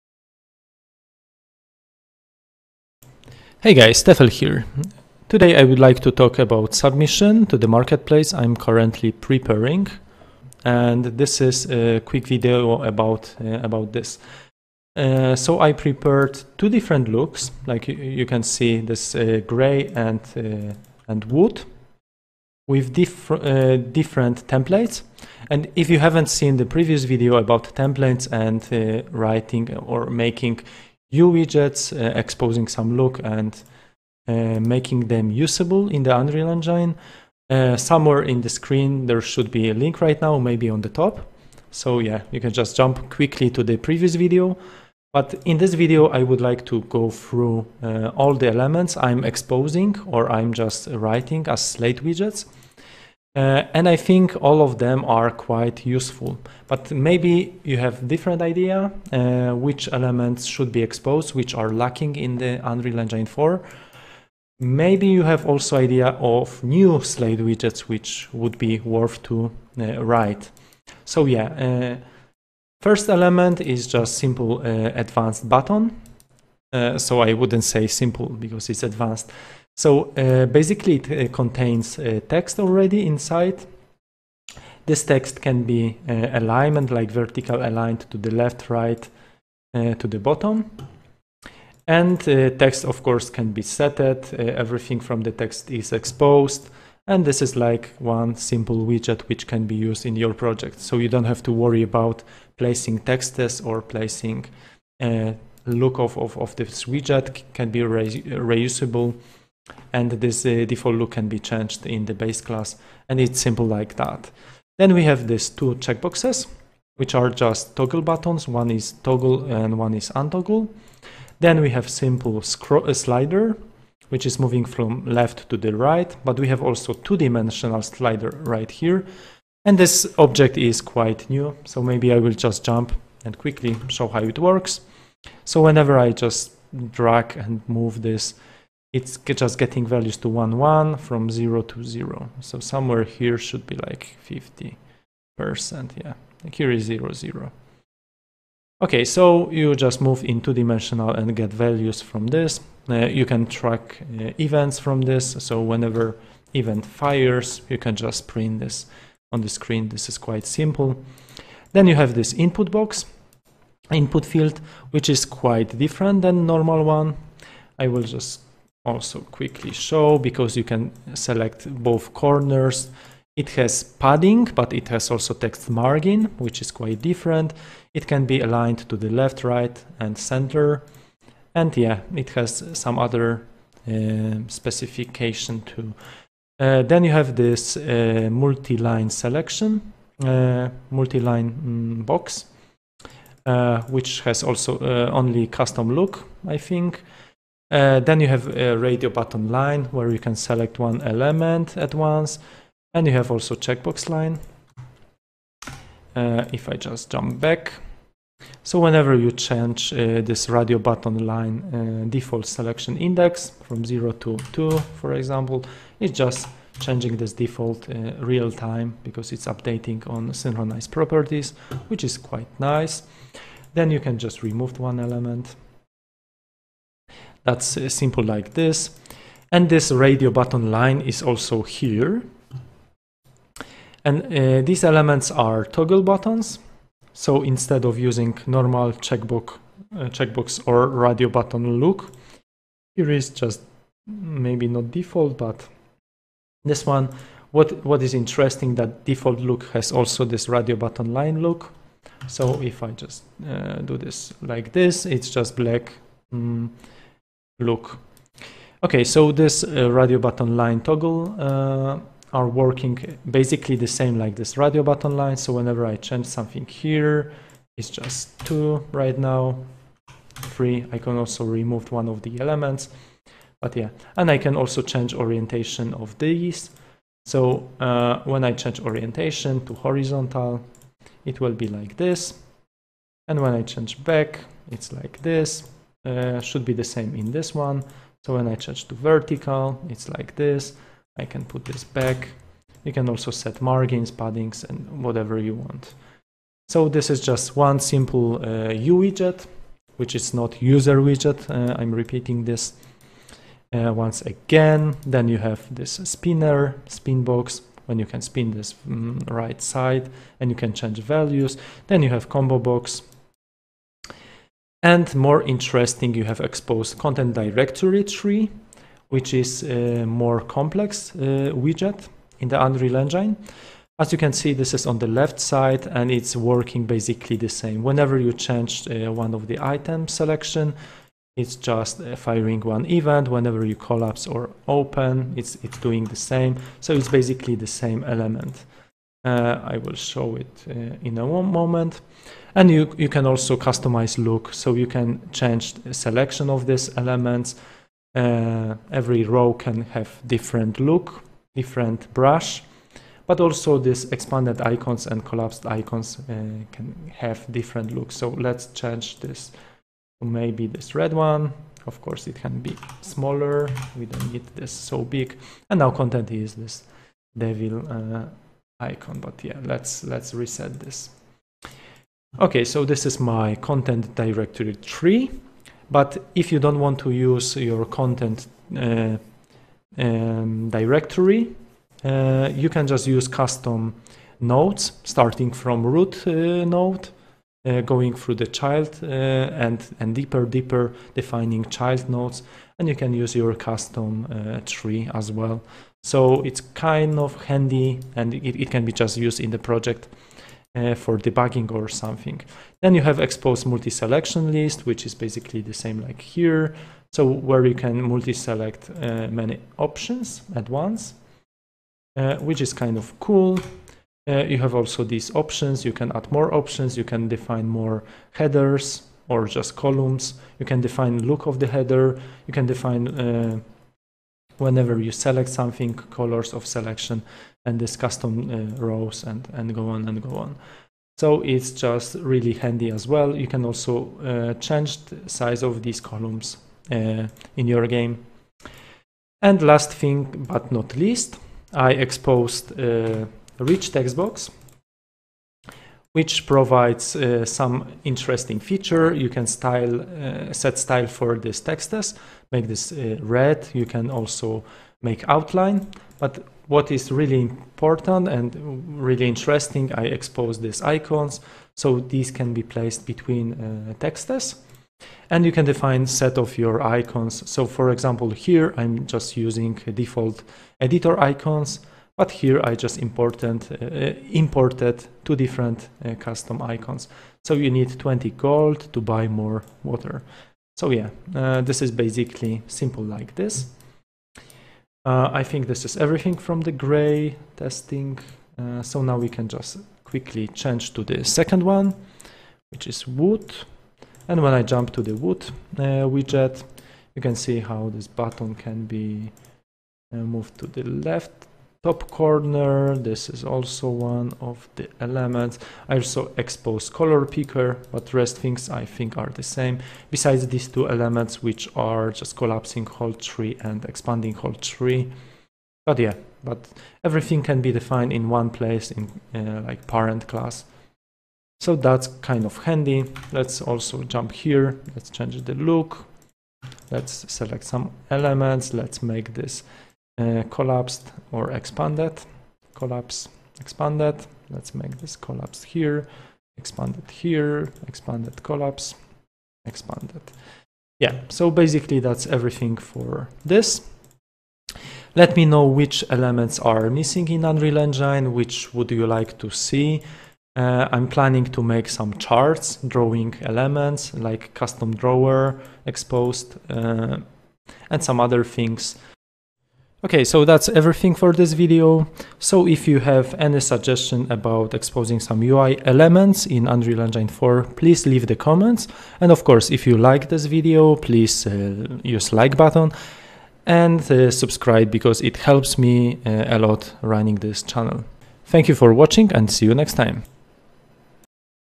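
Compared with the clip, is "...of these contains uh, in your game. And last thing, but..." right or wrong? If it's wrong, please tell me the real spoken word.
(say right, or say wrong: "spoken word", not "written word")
wrong: "columns", not "contains".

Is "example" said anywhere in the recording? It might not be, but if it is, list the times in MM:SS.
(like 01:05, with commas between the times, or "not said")
03:35, 07:47.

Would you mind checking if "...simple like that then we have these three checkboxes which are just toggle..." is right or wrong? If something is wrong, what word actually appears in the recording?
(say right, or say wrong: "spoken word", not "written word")
wrong: "two", not "three".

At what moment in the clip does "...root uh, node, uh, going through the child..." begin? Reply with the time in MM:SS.
06:25.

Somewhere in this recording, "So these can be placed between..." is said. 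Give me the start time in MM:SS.
07:41.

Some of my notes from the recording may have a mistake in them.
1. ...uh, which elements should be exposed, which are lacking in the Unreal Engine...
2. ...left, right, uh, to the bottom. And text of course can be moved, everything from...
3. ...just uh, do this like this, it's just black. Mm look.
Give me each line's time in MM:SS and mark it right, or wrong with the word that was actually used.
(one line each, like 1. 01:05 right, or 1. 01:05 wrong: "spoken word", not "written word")
1. 00:59 right
2. 01:28 wrong: "setted", not "moved"
3. 04:12 right.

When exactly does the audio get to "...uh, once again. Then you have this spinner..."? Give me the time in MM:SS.
05:03.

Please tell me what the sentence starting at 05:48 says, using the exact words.
Uh, every row can have different look, different brush but also these expanded icons and collapsed icons uh, can have different looks.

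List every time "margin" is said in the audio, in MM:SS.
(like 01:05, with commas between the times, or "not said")
02:55, 04:53.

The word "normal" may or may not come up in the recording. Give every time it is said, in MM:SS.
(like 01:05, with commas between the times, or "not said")
02:46, 03:58.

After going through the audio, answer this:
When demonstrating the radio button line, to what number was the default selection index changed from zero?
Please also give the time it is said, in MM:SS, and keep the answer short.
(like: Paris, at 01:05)
2, at 03:34.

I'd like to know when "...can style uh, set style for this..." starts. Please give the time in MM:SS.
07:29.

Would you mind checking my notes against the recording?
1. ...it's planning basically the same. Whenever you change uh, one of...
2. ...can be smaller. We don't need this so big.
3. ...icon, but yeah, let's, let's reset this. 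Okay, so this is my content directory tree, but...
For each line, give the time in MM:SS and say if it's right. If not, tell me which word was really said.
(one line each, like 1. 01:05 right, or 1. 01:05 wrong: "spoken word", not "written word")
1. 05:26 wrong: "working", not "planning"
2. 06:02 right
3. 06:08 right.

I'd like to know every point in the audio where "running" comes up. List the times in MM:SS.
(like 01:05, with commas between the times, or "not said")
09:37.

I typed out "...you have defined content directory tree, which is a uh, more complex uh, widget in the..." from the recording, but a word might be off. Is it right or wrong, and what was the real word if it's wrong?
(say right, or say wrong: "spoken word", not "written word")
wrong: "exposed", not "defined".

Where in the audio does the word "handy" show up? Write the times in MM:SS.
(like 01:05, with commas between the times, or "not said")
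06:37, 07:12, 08:42.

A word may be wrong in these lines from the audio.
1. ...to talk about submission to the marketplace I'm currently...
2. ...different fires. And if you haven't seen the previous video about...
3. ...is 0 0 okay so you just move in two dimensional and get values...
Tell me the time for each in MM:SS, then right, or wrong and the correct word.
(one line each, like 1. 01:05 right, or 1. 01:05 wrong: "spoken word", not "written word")
1. 00:05 right
2. 00:23 wrong: "templates", not "fires"
3. 02:26 right.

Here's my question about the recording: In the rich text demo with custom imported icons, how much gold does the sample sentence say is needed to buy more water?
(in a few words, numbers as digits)
20 gold.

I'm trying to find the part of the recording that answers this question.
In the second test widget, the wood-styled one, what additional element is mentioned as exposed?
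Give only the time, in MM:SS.
08:26.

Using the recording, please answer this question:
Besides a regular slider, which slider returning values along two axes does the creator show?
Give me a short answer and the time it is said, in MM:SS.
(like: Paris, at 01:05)
Two-dimensional slider, at 02:06.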